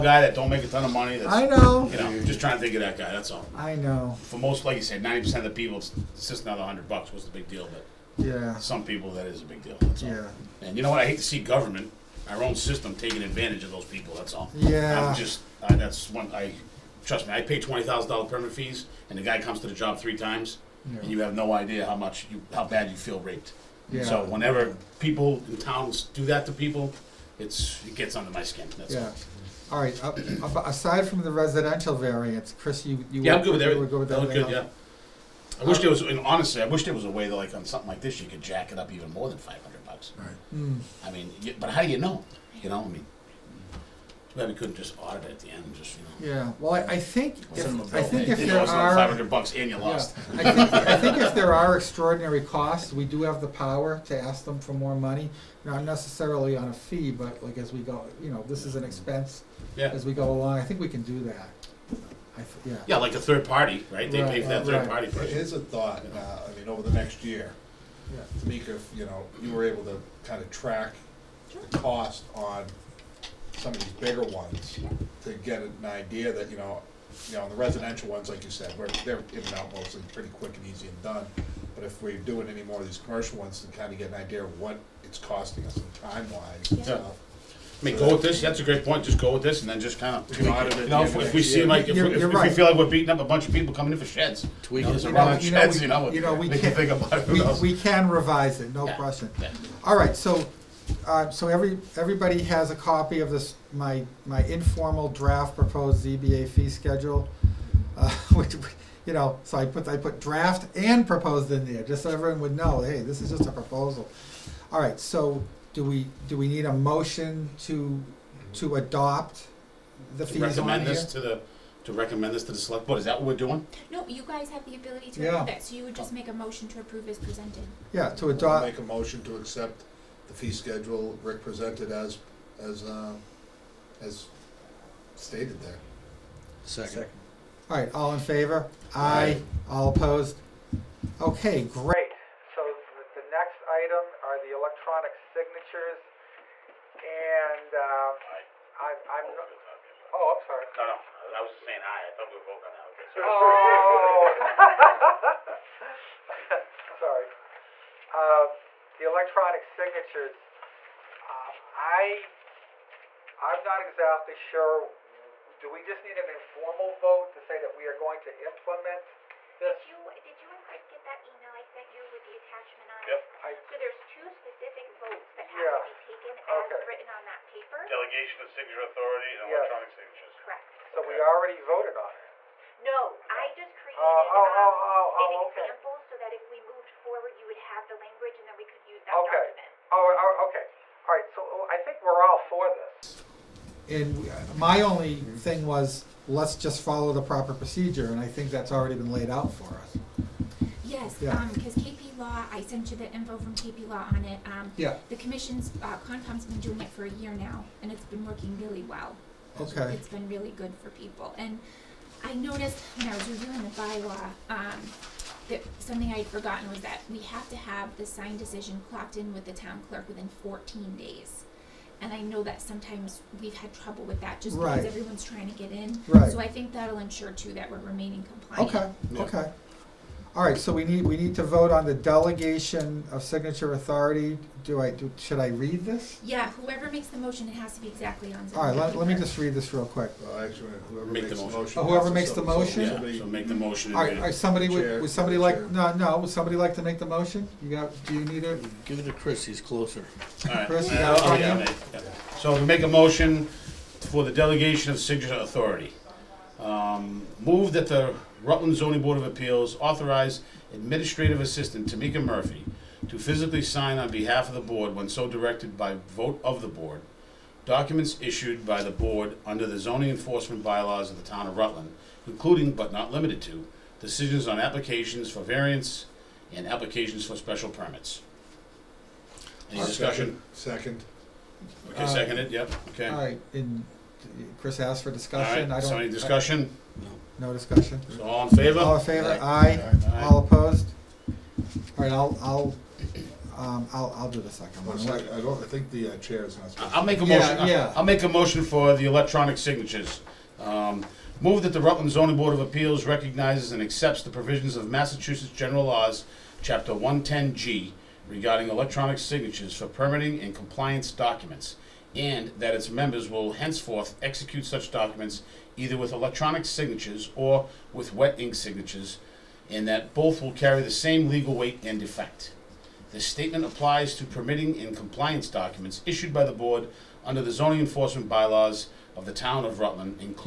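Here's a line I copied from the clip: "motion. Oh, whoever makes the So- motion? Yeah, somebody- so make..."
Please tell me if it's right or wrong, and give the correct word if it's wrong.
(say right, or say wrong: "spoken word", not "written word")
right.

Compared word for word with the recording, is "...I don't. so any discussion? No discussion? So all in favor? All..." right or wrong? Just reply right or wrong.
right.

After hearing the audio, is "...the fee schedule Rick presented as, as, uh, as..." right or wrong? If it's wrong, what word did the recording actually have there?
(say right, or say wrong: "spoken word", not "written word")
right.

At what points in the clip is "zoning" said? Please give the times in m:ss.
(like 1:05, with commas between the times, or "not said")
4:18, 4:29, 5:02, 5:27.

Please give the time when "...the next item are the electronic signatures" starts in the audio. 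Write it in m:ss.
2:23.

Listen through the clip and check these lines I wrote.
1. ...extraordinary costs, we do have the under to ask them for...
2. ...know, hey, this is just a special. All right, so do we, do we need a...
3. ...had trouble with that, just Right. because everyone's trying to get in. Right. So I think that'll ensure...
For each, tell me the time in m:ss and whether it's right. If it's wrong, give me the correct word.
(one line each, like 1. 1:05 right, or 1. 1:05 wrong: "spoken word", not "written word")
1. 0:51 wrong: "power", not "under"
2. 1:52 wrong: "proposal", not "special"
3. 3:43 right.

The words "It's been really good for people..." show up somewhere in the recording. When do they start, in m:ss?
3:29.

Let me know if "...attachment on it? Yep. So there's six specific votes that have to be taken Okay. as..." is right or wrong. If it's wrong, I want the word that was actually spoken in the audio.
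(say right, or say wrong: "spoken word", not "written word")
wrong: "two", not "six".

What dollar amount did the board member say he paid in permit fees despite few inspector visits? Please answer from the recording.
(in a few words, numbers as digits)
$20,000.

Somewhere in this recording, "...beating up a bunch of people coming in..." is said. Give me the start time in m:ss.
1:32.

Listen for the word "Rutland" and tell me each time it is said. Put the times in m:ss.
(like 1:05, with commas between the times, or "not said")
4:18, 4:31, 5:01, 5:29.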